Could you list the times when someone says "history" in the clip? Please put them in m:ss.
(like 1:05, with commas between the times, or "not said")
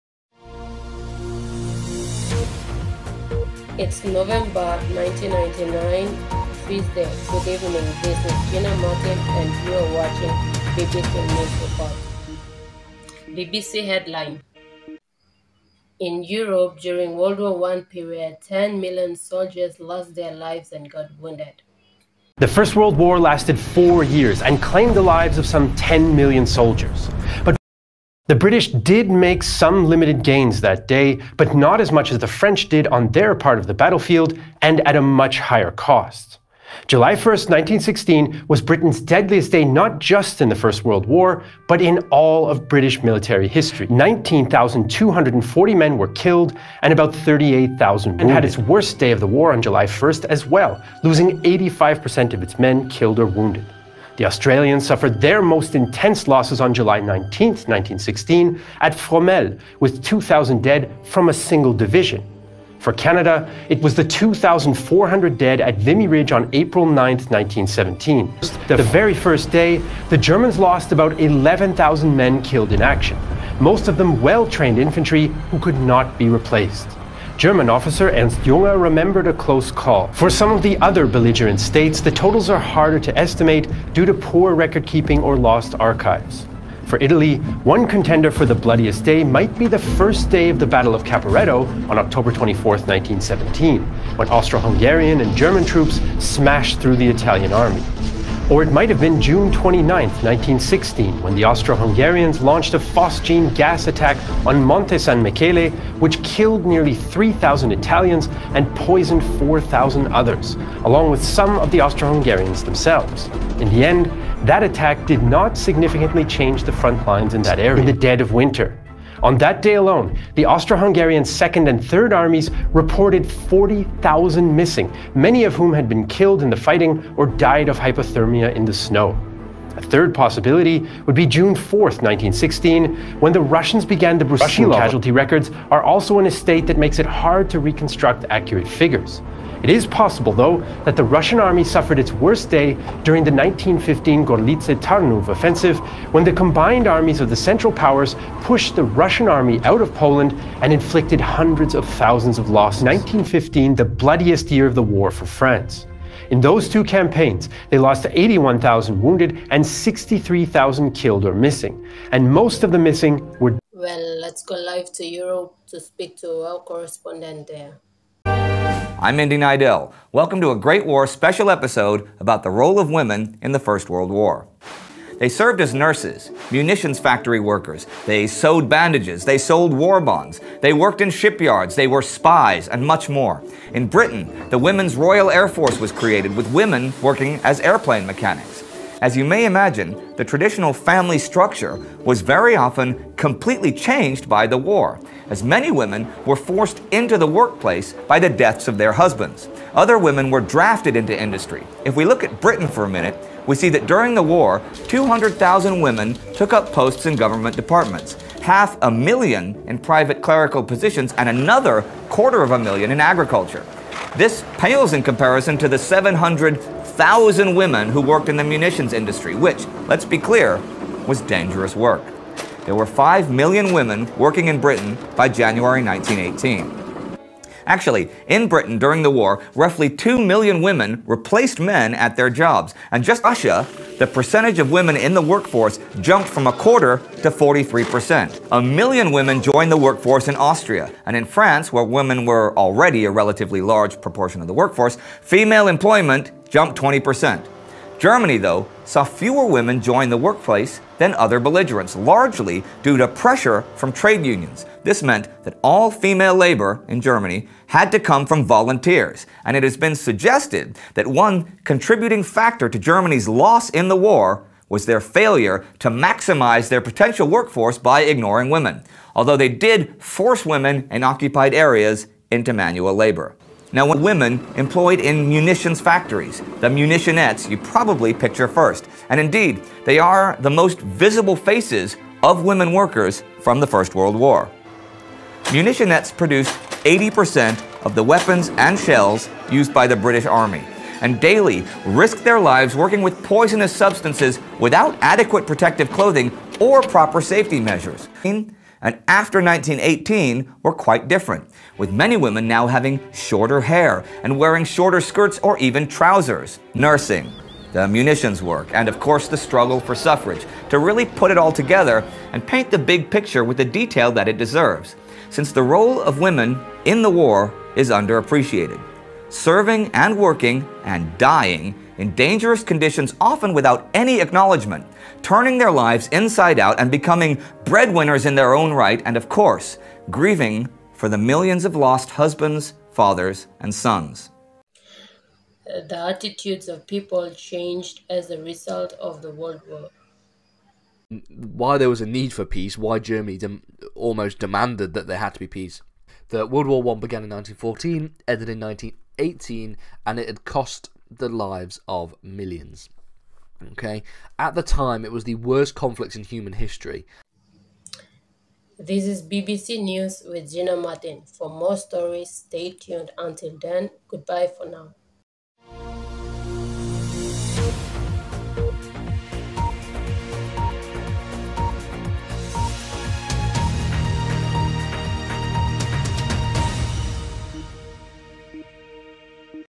0:43, 5:56.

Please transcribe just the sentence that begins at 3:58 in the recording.
A million women joined the workforce in Austria.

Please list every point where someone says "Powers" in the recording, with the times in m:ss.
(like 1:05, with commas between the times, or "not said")
2:27.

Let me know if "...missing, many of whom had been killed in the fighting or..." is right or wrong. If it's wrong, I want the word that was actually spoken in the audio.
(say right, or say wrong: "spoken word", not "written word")
right.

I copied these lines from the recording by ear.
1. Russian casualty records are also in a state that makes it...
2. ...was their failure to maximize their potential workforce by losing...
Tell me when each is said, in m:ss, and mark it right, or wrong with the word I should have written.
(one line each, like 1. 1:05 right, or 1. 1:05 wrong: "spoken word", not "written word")
1. 2:14 right
2. 4:24 wrong: "ignoring", not "losing".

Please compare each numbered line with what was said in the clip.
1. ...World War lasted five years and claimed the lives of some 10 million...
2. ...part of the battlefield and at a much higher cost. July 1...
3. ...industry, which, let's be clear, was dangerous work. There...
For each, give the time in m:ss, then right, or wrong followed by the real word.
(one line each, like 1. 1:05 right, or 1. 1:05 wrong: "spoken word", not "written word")
1. 0:22 wrong: "four", not "five"
2. 0:33 right
3. 3:38 right.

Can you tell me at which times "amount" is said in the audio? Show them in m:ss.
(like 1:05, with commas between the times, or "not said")
not said.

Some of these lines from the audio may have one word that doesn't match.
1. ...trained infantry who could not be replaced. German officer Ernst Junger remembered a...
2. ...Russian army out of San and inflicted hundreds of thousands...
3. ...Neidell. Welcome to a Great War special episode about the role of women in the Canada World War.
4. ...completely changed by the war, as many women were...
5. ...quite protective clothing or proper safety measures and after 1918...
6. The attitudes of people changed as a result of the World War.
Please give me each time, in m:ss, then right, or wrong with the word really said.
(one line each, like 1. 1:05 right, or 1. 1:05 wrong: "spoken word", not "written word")
1. 1:14 right
2. 2:28 wrong: "Poland", not "San"
3. 2:49 wrong: "First", not "Canada"
4. 3:13 right
5. 4:55 wrong: "adequate", not "quite"
6. 5:35 right.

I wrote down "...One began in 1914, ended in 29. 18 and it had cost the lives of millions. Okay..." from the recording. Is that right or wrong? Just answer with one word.
wrong.